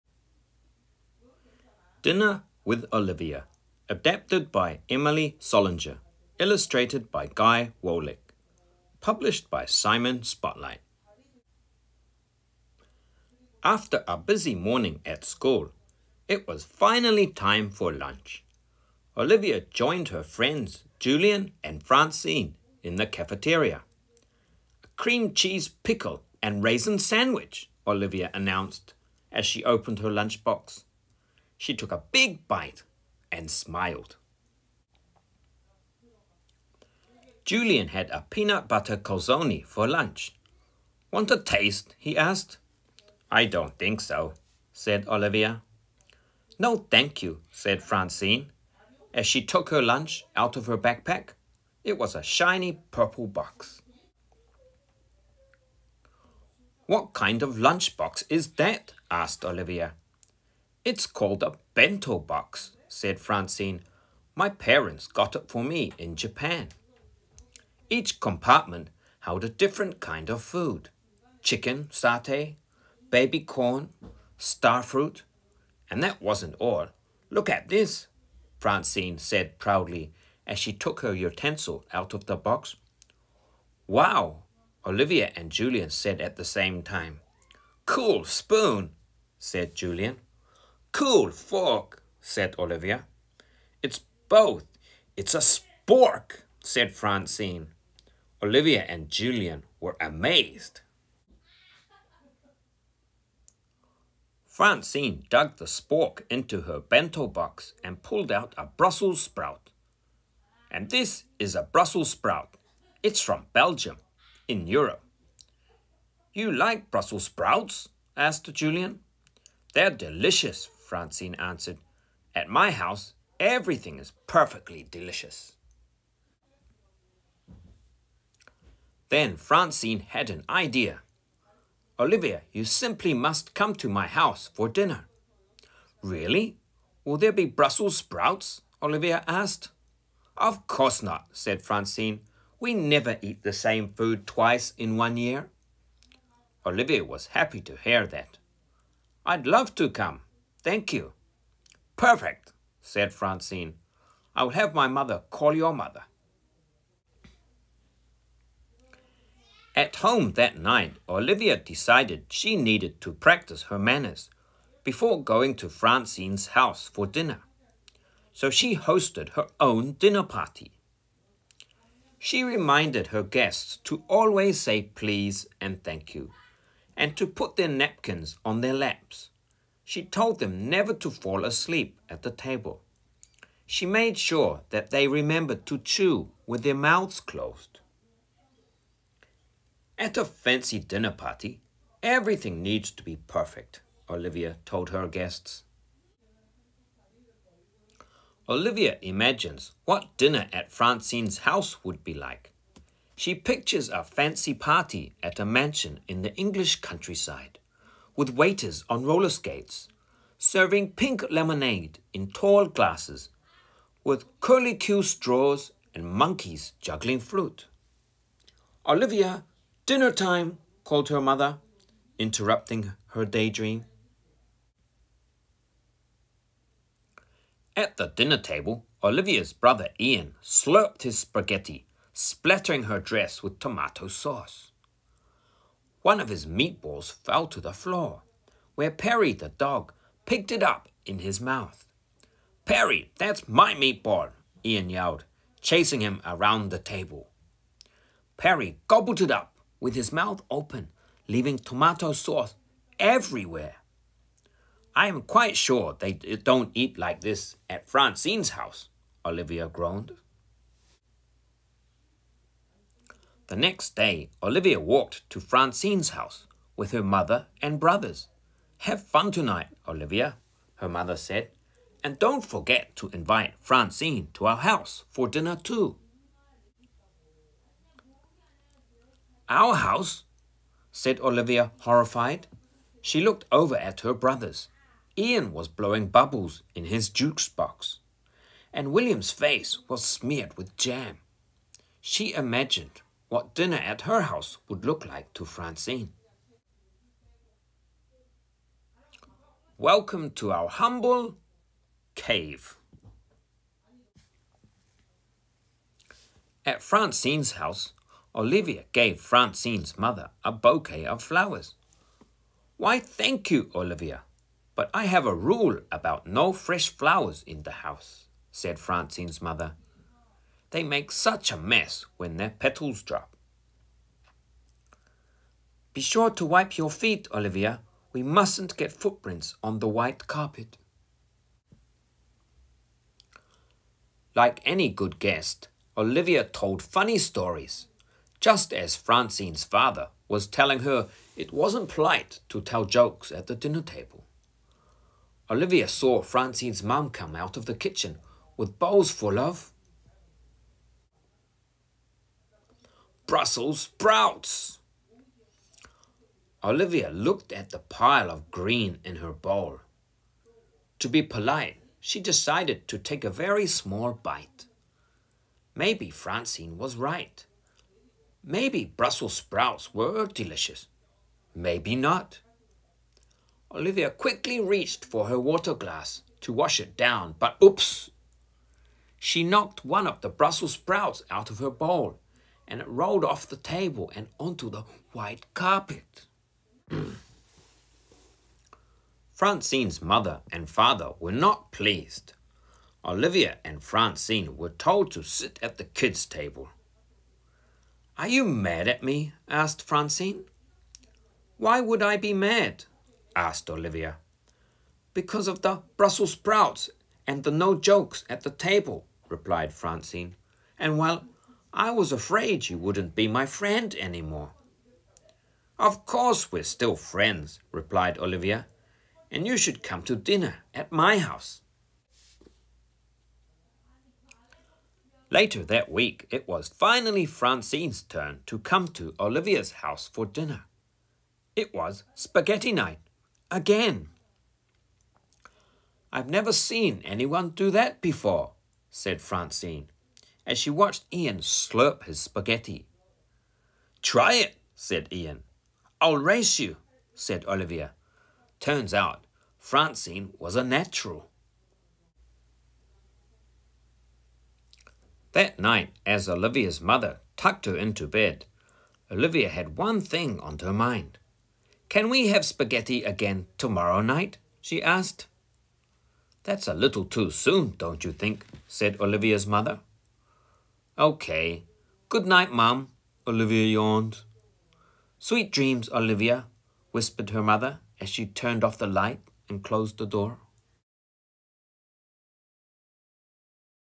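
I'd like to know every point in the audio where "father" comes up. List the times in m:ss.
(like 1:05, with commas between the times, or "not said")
5:39, 6:30.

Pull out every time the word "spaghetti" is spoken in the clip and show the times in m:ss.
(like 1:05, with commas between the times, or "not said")
3:51, 7:12, 7:22, 7:42.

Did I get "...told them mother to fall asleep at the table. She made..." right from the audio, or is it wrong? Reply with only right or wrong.
wrong.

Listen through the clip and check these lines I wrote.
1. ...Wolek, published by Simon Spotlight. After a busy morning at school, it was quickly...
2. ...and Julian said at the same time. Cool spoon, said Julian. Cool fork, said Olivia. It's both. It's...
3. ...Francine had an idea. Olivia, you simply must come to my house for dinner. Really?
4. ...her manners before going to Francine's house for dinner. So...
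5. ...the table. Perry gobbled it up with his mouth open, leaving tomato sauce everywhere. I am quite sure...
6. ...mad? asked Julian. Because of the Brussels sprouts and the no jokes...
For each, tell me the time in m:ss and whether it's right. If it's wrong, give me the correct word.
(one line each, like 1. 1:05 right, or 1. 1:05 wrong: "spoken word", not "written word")
1. 0:07 wrong: "finally", not "quickly"
2. 1:25 right
3. 2:09 right
4. 2:43 right
5. 4:06 right
6. 6:42 wrong: "Olivia", not "Julian".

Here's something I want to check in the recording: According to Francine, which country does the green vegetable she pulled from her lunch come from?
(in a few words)
Belgium.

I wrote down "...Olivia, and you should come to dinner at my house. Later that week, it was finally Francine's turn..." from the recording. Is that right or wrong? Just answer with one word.
right.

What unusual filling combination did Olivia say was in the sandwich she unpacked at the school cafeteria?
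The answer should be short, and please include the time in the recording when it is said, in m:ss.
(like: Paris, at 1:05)
Cream cheese pickle and raisin, at 0:24.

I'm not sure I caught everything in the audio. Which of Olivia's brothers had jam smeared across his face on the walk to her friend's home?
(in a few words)
William.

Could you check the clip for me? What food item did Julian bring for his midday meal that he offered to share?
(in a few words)
Peanut butter calzone.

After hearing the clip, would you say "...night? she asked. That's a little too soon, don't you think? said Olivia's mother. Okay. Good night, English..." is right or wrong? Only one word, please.
wrong.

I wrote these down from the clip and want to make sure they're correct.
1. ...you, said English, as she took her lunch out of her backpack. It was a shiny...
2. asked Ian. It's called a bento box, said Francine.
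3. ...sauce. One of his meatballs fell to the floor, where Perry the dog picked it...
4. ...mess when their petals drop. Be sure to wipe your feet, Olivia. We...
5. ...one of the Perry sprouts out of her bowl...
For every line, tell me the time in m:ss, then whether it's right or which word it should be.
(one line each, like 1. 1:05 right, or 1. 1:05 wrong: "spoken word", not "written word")
1. 0:47 wrong: "Francine", not "English"
2. 0:59 wrong: "Olivia", not "Ian"
3. 3:54 right
4. 5:21 right
5. 6:19 wrong: "Brussels", not "Perry".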